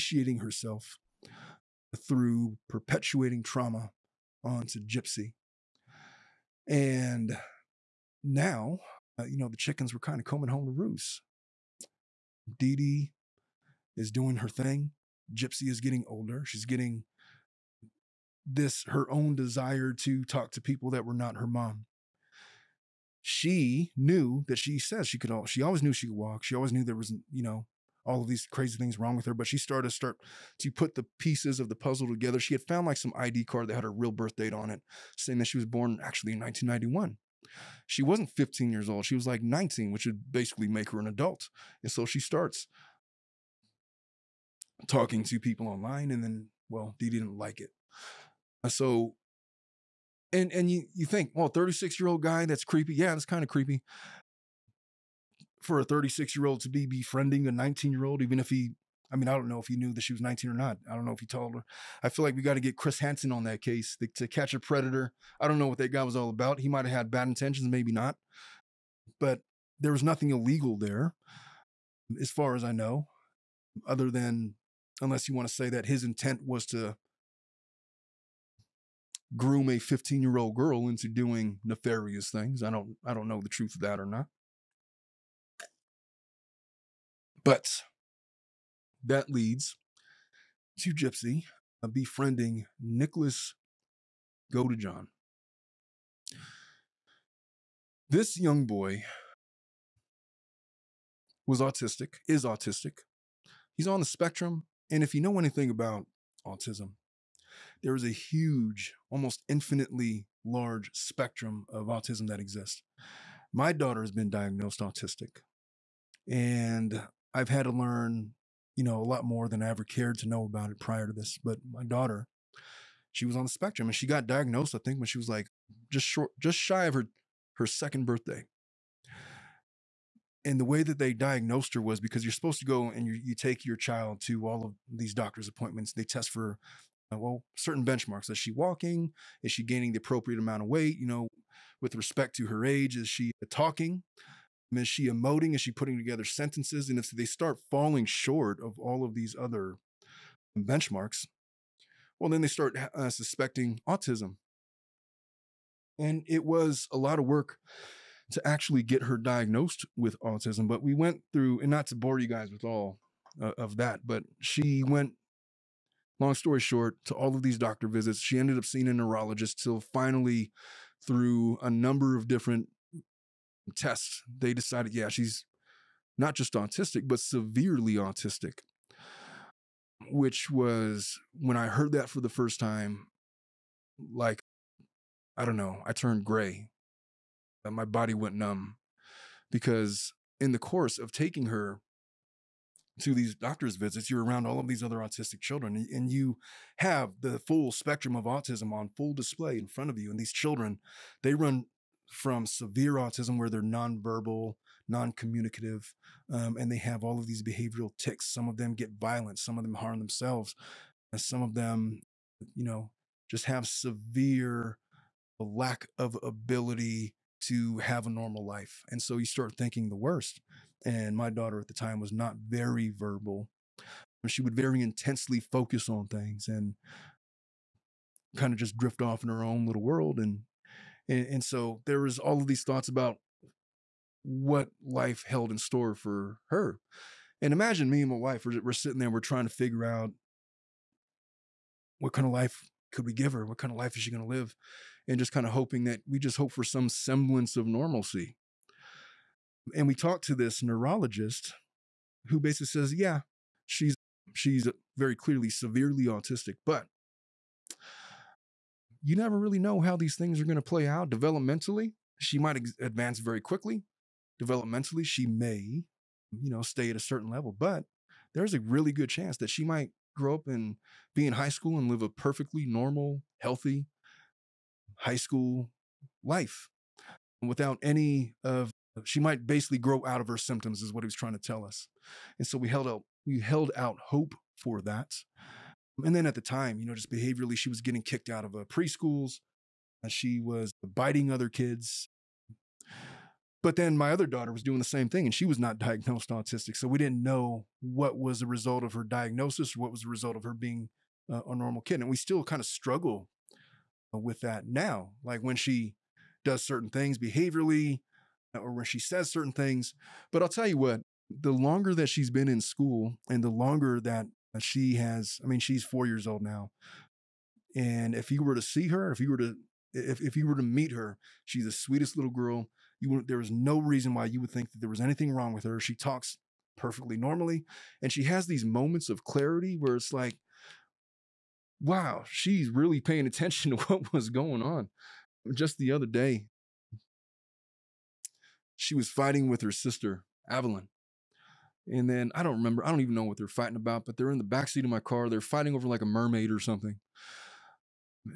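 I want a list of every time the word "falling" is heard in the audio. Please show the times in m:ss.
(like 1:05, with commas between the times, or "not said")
2:27.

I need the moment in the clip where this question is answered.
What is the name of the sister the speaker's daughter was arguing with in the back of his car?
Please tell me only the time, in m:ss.
5:40.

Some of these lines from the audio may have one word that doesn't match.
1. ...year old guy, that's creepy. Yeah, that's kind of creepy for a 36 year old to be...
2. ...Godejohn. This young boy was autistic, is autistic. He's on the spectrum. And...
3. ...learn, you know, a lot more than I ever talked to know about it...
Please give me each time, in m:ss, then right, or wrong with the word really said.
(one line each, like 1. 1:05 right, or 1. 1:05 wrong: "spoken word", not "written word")
1. 0:52 right
2. 1:34 right
3. 1:57 wrong: "cared", not "talked".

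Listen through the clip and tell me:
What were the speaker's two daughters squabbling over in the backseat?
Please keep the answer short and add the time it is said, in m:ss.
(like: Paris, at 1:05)
A mermaid, at 5:46.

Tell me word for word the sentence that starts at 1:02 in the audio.
I feel like we got to get Chris Hansen on that case to, to catch a predator.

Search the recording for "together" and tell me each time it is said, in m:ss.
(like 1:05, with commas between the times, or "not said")
0:32, 2:25.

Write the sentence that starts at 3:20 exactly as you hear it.
And these children, they run from severe autism where they're nonverbal, non-communicative, um, and they have all of these behavioral ticks.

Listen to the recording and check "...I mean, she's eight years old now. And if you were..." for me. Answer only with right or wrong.
wrong.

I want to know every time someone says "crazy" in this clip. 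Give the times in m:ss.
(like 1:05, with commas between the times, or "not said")
0:28.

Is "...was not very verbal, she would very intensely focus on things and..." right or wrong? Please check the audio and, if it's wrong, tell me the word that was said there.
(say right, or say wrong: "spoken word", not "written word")
right.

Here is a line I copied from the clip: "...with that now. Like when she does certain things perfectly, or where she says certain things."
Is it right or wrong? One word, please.
wrong.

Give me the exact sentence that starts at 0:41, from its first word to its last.
And so she starts talking to people online and then well, they didn't like it.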